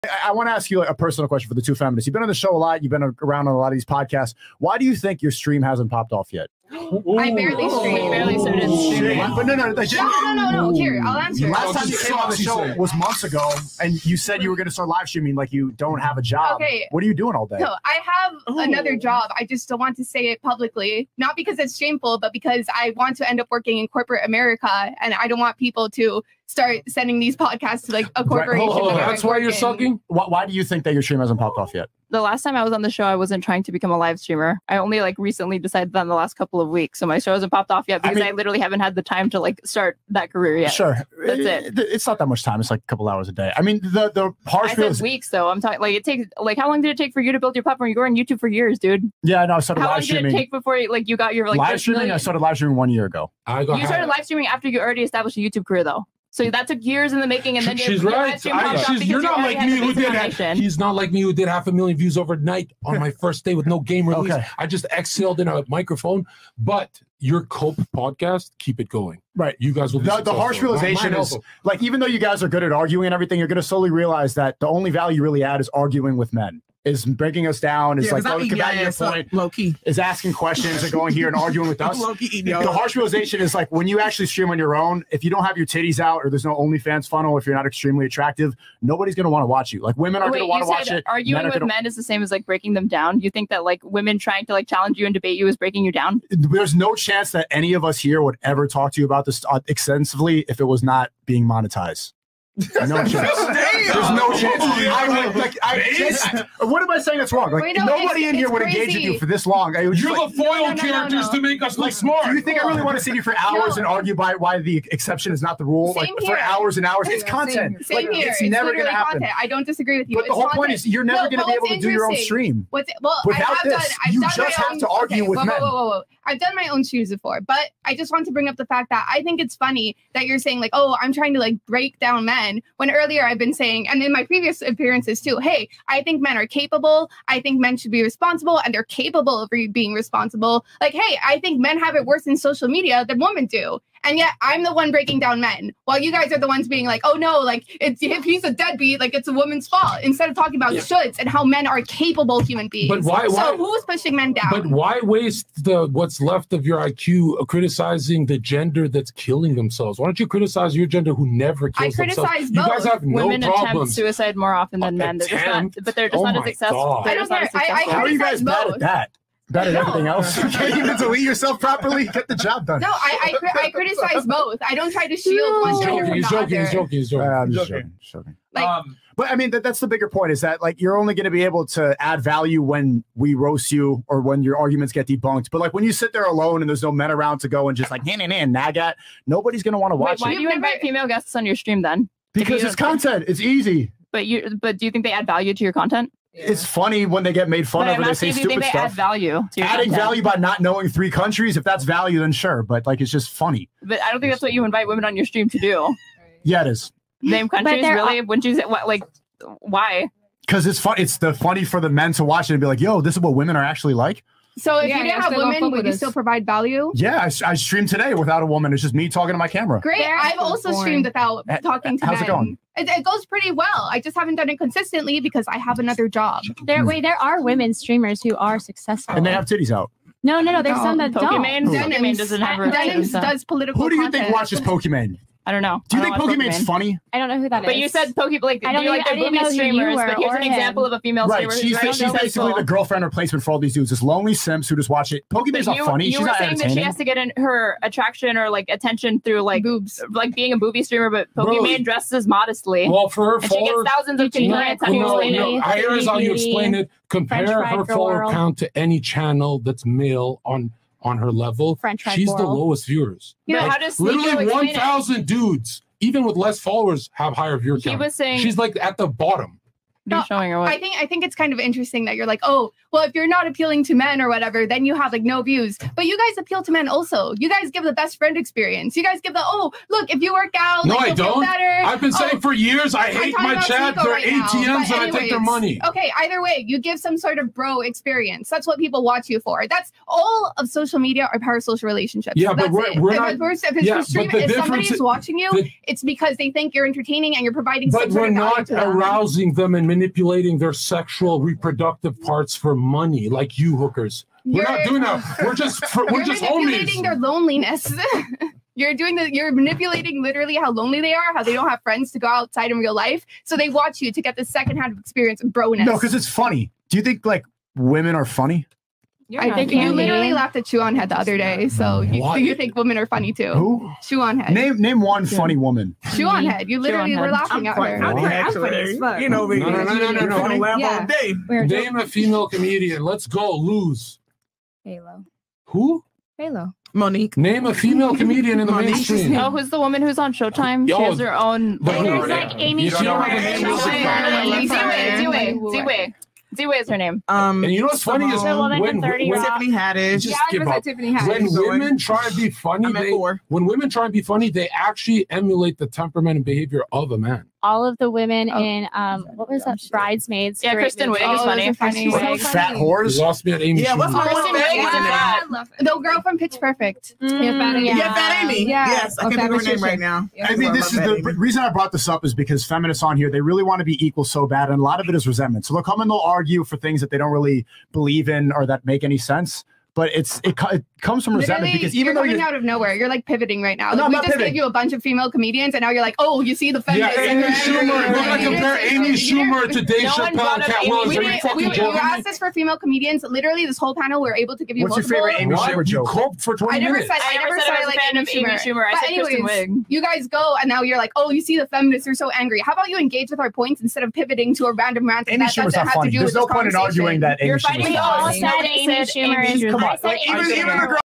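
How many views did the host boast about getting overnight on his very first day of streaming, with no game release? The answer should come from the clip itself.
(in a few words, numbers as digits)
half a million.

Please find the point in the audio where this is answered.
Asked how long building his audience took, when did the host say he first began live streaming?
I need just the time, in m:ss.
0:52.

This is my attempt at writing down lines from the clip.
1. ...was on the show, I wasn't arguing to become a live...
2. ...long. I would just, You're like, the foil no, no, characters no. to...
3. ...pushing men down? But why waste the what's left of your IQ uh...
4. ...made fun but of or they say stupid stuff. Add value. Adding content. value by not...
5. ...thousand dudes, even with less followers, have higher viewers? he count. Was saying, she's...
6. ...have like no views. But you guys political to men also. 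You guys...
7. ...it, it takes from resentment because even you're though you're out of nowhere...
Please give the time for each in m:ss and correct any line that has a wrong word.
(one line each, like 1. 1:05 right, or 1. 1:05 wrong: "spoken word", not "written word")
1. 0:32 wrong: "trying", not "arguing"
2. 1:49 right
3. 2:33 right
4. 3:17 right
5. 4:24 right
6. 4:34 wrong: "appeal", not "political"
7. 6:20 wrong: "comes", not "takes".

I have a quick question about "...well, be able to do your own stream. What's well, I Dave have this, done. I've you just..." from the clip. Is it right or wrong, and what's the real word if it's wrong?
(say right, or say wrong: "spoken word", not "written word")
wrong: "Without", not "Dave".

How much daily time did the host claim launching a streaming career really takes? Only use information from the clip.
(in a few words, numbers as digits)
a couple hours a day.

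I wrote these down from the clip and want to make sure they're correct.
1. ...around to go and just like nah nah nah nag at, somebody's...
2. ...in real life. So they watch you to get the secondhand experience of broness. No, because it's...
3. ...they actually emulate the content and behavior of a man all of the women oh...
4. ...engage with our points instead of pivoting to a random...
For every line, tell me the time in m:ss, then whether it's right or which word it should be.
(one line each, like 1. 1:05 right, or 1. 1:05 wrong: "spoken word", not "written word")
1. 3:07 wrong: "nobody", not "somebody"
2. 5:12 right
3. 5:54 wrong: "temperament", not "content"
4. 6:42 right.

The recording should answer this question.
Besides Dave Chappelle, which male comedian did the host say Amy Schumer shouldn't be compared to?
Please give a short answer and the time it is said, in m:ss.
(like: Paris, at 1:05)
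Katt Williams, at 6:30.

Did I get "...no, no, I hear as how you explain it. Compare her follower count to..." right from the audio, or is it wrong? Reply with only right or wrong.
right.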